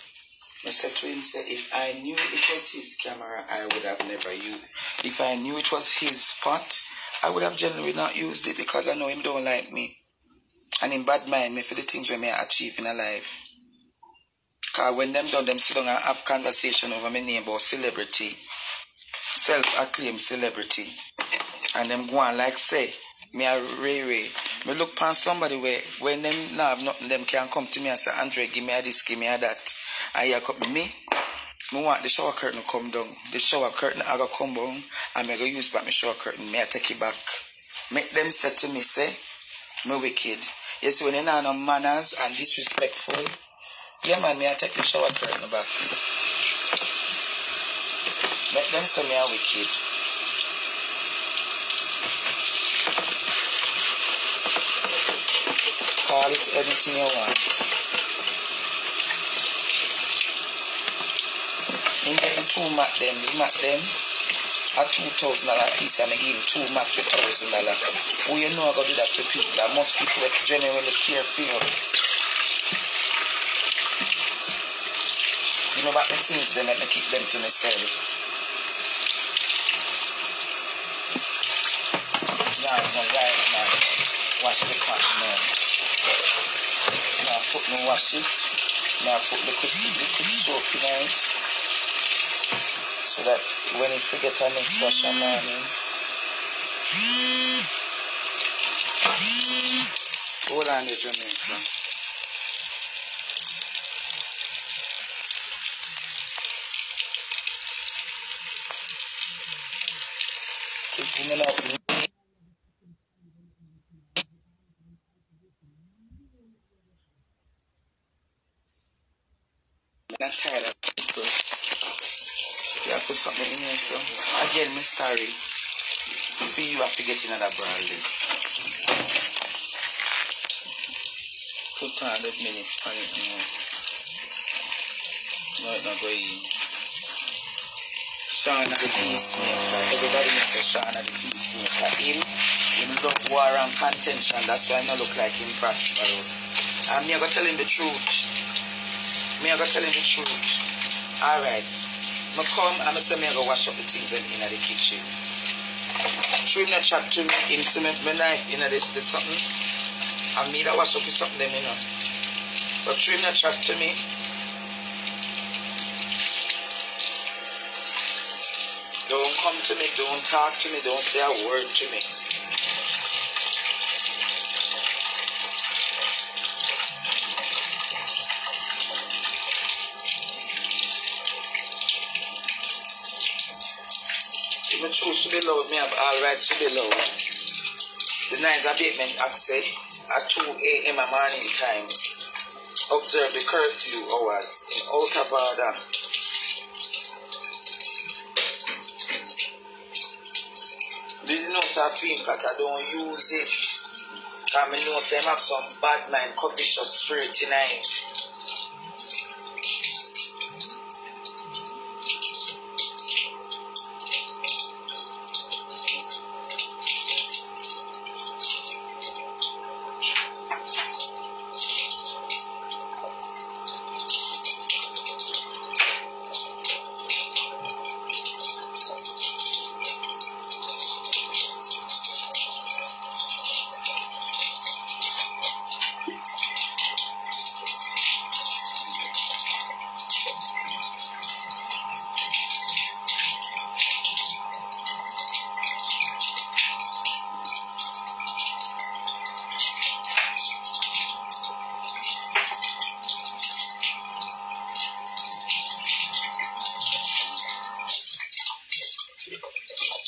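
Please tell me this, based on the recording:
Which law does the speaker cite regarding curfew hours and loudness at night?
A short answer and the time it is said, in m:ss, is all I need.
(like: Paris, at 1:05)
Noise Abatement Act, at 3:08.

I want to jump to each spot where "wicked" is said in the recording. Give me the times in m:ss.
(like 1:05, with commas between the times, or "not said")
0:39, 0:49.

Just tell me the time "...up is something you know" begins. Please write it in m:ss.
2:40.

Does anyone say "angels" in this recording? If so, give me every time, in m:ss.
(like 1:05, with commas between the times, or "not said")
not said.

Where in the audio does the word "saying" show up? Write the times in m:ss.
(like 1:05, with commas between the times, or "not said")
not said.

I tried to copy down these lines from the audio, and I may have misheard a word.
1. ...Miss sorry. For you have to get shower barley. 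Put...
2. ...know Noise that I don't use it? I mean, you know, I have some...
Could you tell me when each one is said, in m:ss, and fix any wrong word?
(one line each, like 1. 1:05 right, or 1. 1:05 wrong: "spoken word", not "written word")
1. 2:04 wrong: "another", not "shower"
2. 3:21 wrong: "Safin", not "Noise".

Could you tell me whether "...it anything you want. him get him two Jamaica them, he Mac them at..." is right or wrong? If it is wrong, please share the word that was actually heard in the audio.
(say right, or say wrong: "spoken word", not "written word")
wrong: "Mac", not "Jamaica".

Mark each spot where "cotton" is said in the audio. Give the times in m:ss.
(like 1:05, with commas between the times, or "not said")
1:24.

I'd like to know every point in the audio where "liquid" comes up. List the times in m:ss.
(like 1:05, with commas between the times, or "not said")
1:29.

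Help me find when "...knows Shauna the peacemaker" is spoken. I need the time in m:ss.
2:20.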